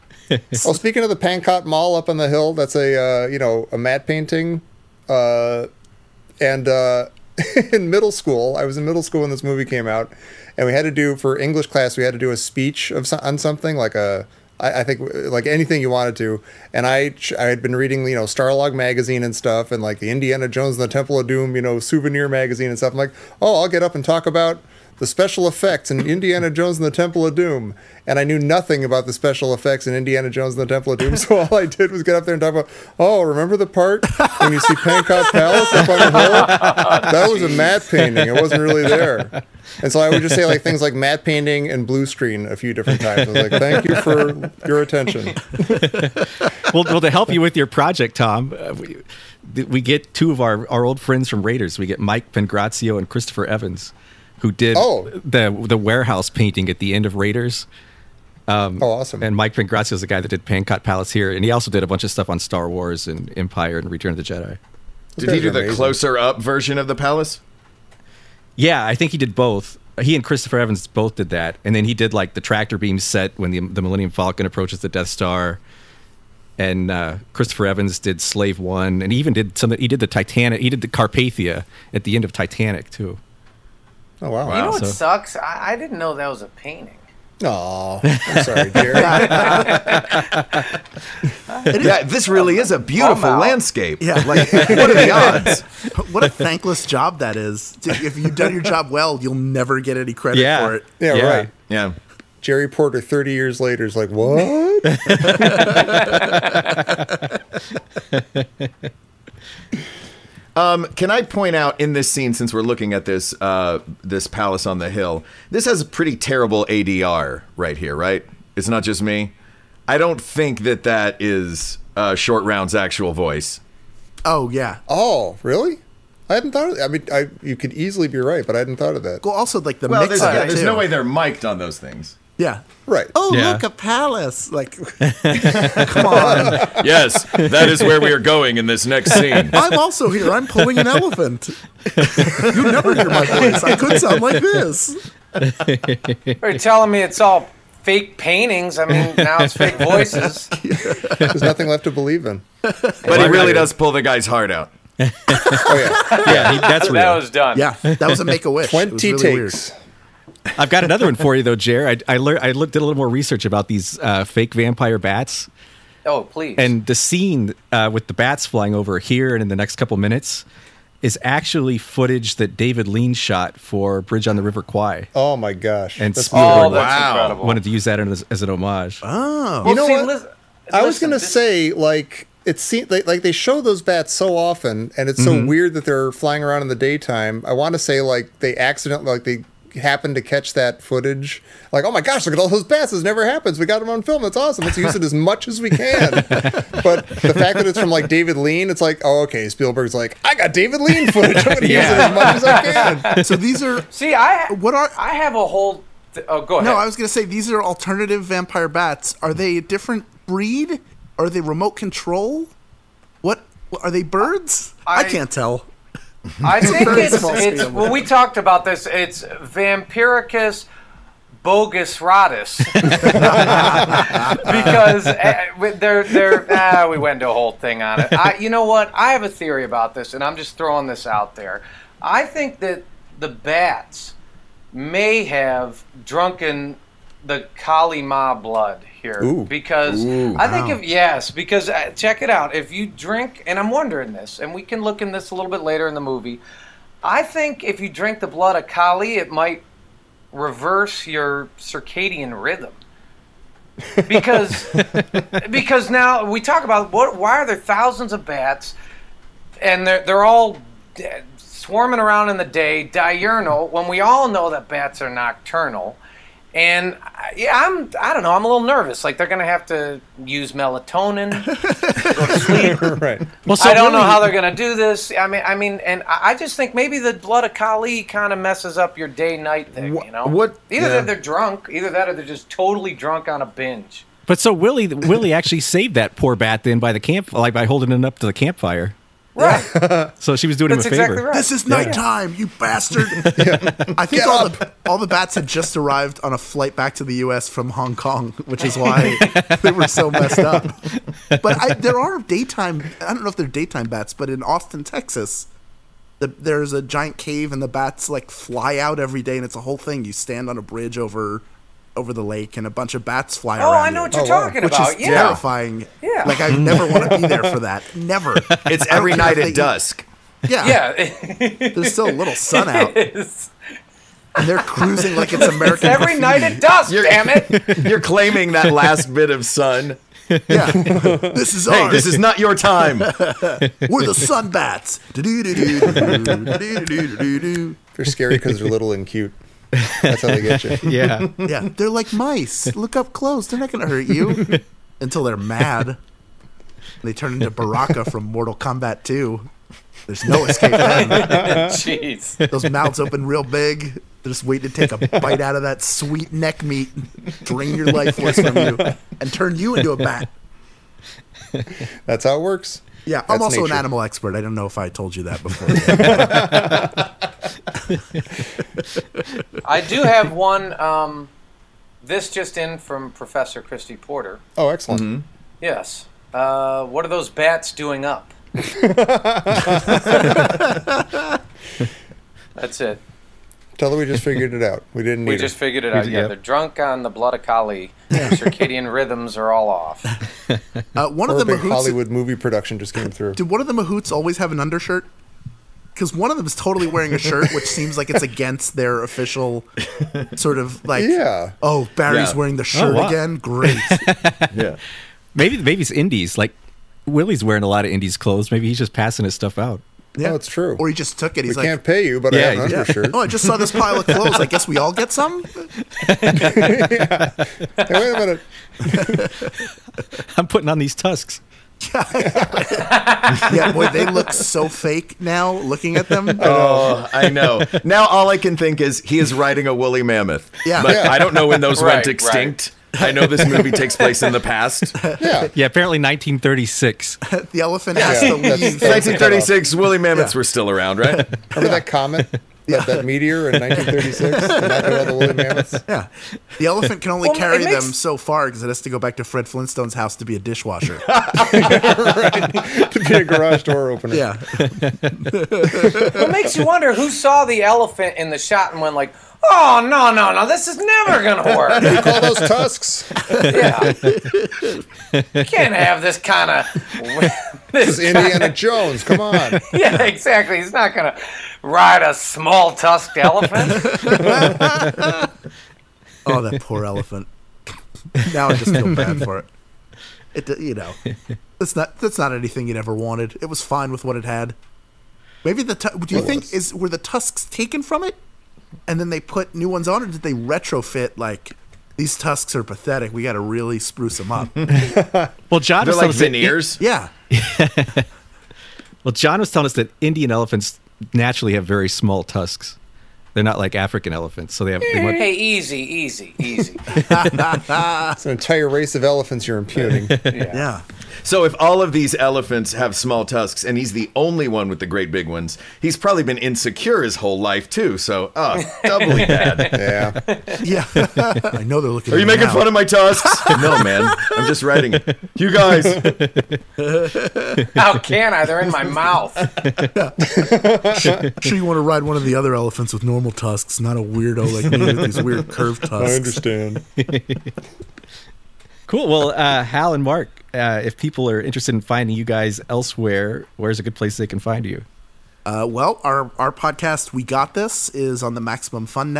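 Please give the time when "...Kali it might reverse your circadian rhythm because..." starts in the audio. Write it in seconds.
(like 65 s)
248 s.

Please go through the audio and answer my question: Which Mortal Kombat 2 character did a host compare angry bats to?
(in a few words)
Baraka.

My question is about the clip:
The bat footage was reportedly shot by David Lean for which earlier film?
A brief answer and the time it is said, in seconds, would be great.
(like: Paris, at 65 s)
Bridge on the River Kwai, at 174 s.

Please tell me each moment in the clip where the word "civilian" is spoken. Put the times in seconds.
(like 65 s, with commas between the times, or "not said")
not said.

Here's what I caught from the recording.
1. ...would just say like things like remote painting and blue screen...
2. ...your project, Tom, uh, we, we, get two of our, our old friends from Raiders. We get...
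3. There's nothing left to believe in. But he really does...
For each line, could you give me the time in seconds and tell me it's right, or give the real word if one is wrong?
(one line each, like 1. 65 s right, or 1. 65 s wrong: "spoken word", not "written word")
1. 40 s wrong: "matte", not "remote"
2. 47 s right
3. 151 s right.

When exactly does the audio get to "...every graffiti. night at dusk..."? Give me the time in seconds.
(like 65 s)
325 s.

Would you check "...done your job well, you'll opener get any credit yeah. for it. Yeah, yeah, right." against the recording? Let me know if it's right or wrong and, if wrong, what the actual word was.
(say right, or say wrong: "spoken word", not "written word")
wrong: "never", not "opener".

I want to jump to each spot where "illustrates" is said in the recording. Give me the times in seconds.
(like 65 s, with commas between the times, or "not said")
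not said.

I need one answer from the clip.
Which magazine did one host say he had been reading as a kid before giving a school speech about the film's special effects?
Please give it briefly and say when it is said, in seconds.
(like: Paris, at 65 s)
Starlog, at 18 s.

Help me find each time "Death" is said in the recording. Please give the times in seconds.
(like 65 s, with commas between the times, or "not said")
74 s.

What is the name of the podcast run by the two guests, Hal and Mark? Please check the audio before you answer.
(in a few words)
We Got This.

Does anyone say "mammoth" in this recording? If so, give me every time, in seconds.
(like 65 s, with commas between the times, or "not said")
430 s, 439 s.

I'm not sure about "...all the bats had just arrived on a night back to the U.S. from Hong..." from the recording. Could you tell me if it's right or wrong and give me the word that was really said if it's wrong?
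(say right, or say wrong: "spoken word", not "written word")
wrong: "flight", not "night".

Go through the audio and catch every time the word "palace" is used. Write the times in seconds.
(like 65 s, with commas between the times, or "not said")
35 s, 60 s, 66 s, 114 s, 133 s.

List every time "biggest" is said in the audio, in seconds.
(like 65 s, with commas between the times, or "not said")
not said.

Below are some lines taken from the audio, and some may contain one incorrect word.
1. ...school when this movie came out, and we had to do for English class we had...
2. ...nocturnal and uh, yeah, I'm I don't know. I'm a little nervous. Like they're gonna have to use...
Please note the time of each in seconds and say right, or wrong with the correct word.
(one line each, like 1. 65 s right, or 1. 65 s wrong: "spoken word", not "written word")
1. 9 s right
2. 265 s right.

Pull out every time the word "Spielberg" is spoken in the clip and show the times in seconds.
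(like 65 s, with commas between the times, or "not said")
176 s, 199 s.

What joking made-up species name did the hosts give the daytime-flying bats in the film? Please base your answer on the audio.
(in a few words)
Vampiricus bogus rotus.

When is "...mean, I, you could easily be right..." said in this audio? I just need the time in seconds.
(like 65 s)
126 s.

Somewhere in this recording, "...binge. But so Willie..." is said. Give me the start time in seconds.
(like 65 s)
283 s.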